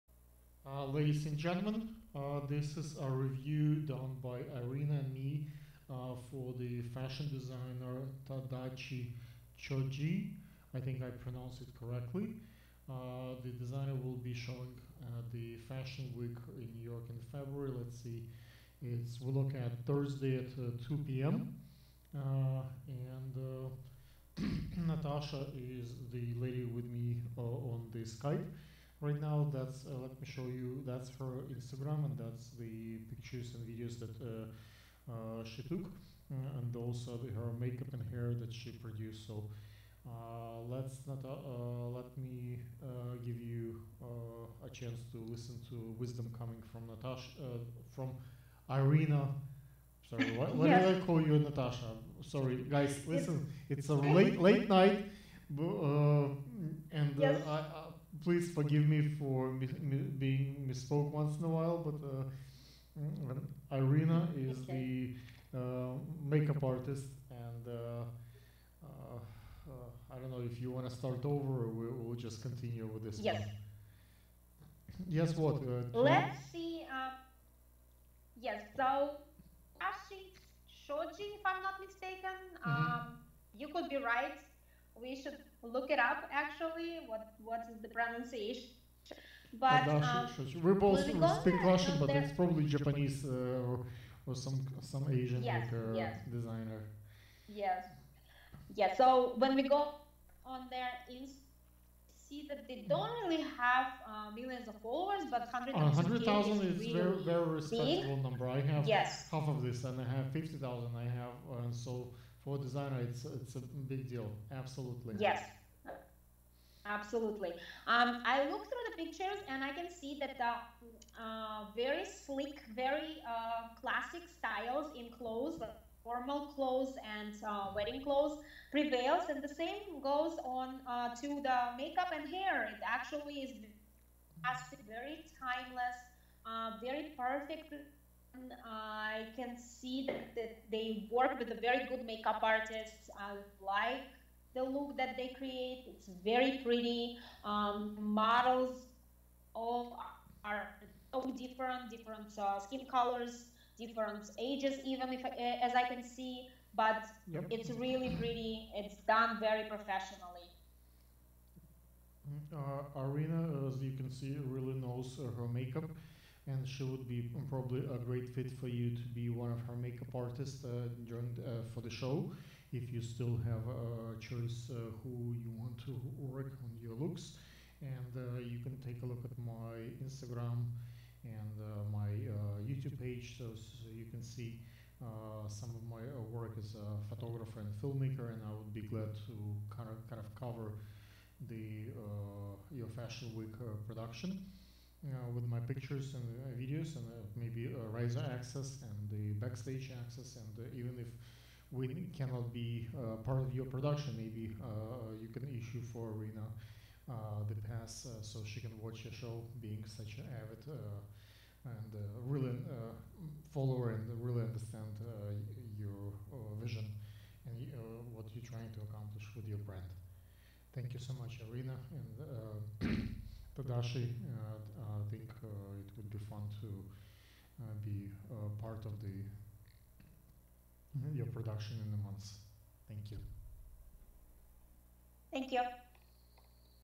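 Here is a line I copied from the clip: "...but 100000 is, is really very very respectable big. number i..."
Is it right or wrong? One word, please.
right.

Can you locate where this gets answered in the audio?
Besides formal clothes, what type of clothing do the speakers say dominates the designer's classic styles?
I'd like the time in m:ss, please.
2:07.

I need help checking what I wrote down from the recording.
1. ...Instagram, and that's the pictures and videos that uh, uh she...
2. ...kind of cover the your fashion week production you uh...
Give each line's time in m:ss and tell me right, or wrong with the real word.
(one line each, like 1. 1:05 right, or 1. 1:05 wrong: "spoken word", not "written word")
1. 0:31 right
2. 3:10 right.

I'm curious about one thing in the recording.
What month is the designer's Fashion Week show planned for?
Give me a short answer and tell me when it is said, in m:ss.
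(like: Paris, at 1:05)
February, at 0:17.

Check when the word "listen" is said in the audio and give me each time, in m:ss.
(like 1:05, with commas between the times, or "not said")
0:45, 0:53.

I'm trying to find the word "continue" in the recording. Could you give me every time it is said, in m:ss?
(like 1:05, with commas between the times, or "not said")
1:12.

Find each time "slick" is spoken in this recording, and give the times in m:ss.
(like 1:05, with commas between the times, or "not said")
2:02.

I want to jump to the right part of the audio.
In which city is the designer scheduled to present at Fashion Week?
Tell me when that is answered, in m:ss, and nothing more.
0:16.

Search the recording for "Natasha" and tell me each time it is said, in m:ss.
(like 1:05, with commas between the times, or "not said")
0:24, 0:46, 0:51.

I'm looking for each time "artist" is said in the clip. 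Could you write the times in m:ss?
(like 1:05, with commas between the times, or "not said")
1:06, 2:22, 2:50.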